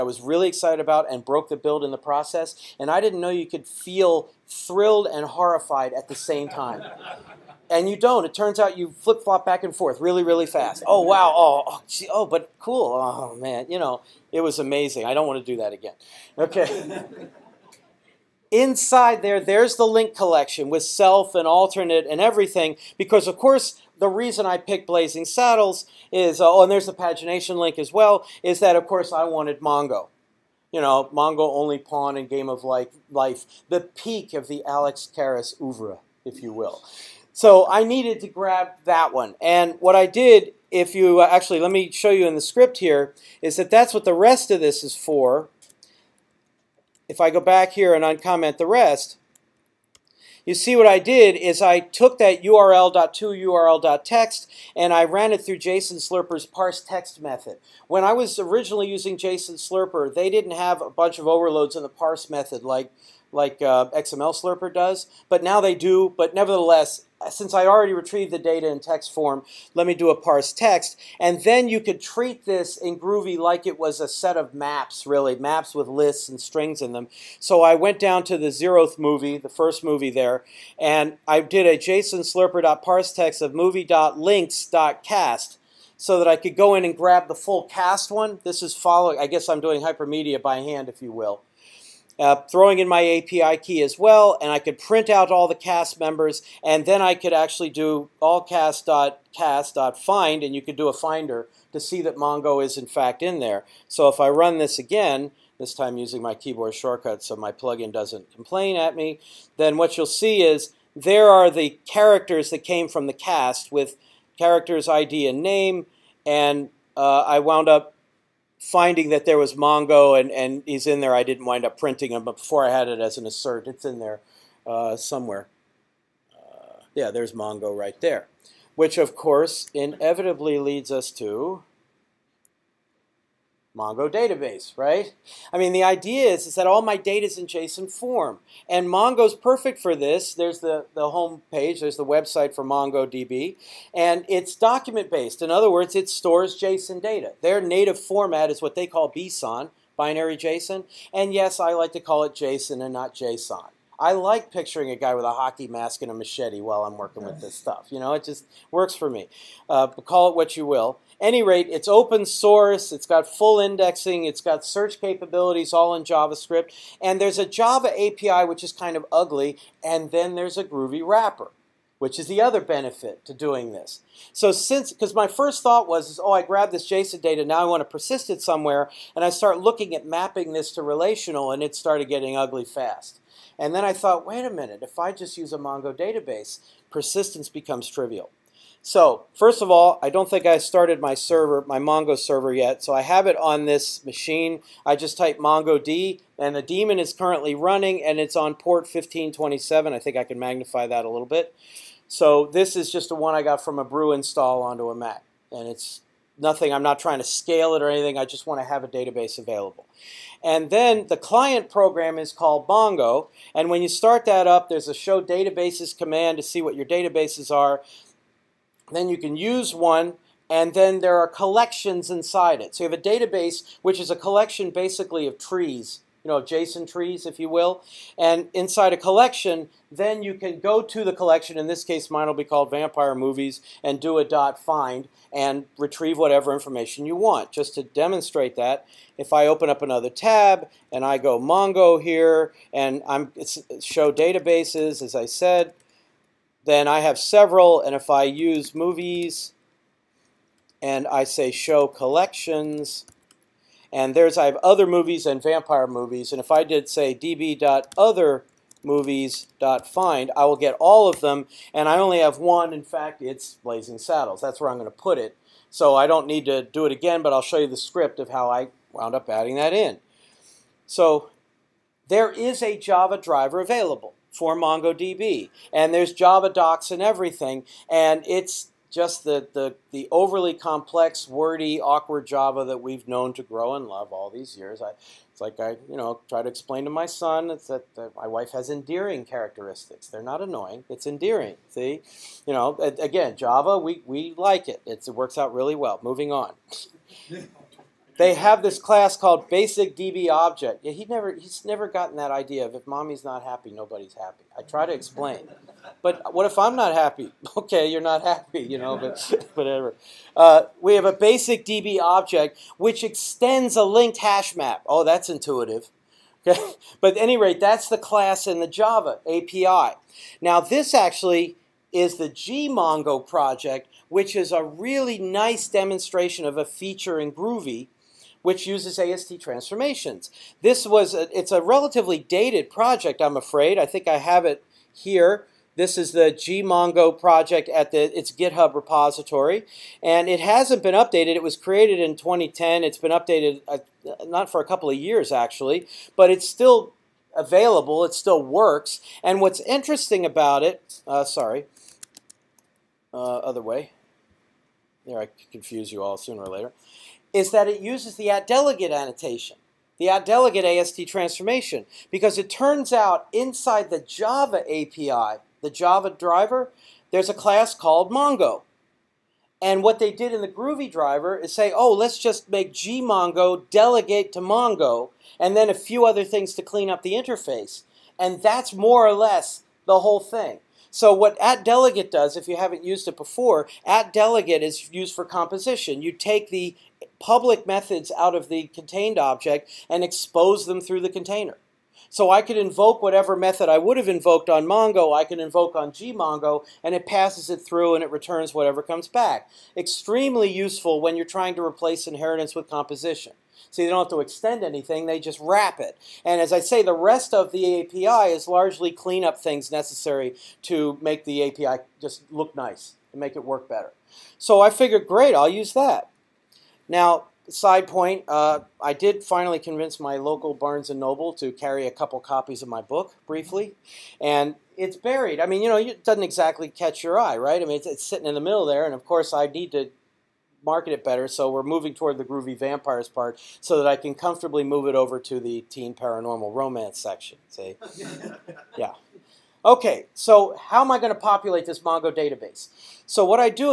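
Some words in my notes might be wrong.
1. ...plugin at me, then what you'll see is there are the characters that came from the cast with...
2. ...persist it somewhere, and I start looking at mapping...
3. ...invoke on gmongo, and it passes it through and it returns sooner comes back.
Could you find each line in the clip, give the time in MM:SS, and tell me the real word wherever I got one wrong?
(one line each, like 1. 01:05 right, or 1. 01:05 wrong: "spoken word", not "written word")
1. 01:48 wrong: "complain", not "plugin"
2. 02:57 right
3. 06:35 wrong: "whatever", not "sooner".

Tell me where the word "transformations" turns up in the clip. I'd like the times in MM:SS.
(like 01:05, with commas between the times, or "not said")
05:29, 06:01.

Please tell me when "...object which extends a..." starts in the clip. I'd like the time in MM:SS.
05:12.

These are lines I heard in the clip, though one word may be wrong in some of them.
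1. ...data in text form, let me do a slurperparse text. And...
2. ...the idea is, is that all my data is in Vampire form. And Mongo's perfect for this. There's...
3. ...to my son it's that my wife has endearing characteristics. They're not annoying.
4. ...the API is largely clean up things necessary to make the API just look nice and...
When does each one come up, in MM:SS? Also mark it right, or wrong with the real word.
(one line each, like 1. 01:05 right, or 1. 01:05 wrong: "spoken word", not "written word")
1. 01:08 wrong: "parse", not "slurperparse"
2. 02:15 wrong: "JSON", not "Vampire"
3. 04:46 right
4. 06:47 right.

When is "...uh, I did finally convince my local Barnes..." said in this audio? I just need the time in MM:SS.
06:58.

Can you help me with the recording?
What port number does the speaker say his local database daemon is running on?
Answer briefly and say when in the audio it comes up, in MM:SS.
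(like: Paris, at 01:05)
1527, at 03:18.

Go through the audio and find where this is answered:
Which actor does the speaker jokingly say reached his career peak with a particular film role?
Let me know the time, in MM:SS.
00:34.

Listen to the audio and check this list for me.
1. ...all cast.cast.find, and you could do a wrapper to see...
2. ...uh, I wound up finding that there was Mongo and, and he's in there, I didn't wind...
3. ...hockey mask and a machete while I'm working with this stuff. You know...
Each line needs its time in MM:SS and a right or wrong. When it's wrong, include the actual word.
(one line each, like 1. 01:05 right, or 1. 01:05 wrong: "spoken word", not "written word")
1. 01:38 wrong: "finder", not "wrapper"
2. 01:56 right
3. 02:35 right.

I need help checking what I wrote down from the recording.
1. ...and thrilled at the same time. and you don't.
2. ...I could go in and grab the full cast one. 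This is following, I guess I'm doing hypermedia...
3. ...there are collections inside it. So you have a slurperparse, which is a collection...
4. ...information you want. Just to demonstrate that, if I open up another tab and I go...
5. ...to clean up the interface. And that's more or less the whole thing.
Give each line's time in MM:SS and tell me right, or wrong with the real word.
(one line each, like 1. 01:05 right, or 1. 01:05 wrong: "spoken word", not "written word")
1. 00:05 wrong: "horrified", not "thrilled"
2. 01:26 right
3. 03:41 wrong: "database", not "slurperparse"
4. 03:56 right
5. 06:16 right.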